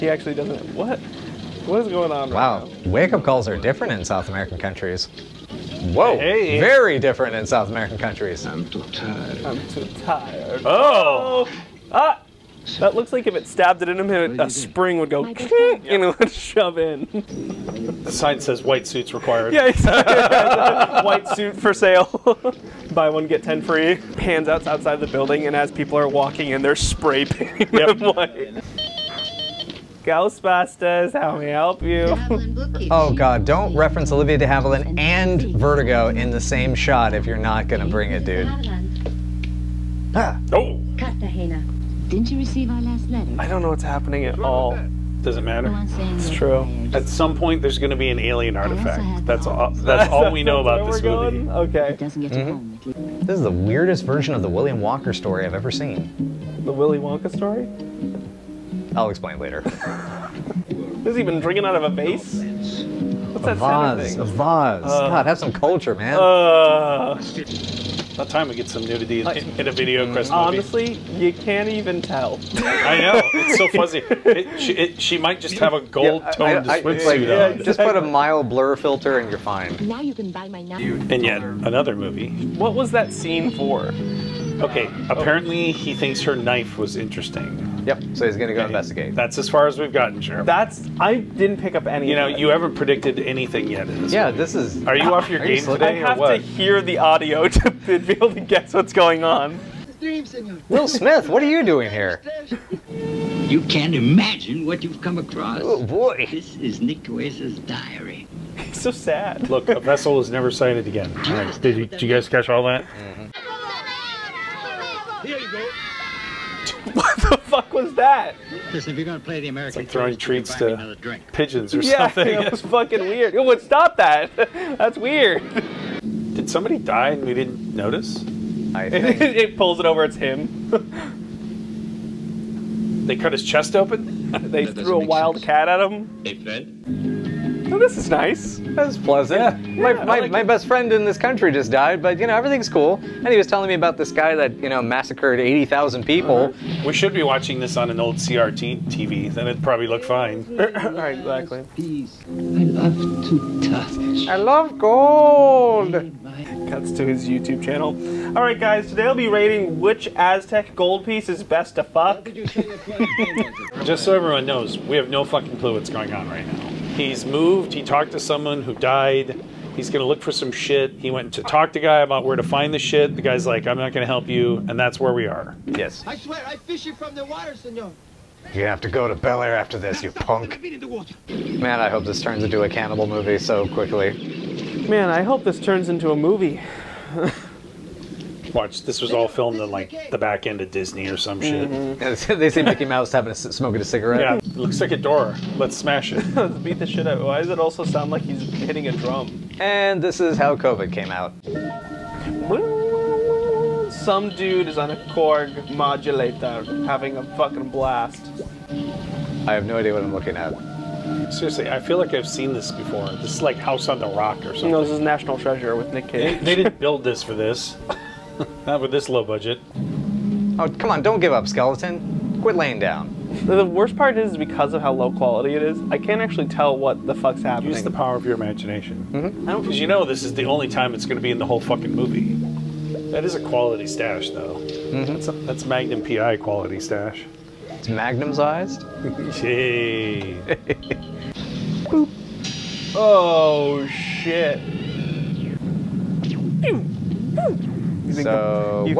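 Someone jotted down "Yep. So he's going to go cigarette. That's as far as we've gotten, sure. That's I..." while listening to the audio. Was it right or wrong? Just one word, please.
wrong.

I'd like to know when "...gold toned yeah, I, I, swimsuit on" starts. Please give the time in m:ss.
1:15.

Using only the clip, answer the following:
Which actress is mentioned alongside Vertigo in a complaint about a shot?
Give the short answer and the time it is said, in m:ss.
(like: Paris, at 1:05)
Olivia de Havilland, at 0:34.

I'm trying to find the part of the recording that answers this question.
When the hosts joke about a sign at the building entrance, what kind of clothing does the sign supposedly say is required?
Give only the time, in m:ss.
0:18.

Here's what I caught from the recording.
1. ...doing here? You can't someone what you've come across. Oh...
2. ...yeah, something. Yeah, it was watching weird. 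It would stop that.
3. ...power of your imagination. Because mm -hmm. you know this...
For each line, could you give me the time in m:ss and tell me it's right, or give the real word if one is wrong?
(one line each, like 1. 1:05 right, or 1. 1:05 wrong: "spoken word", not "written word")
1. 1:41 wrong: "imagine", not "someone"
2. 2:01 wrong: "fucking", not "watching"
3. 3:47 right.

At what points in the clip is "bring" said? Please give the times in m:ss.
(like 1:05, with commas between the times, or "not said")
0:37.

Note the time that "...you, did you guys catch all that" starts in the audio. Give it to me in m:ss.
1:51.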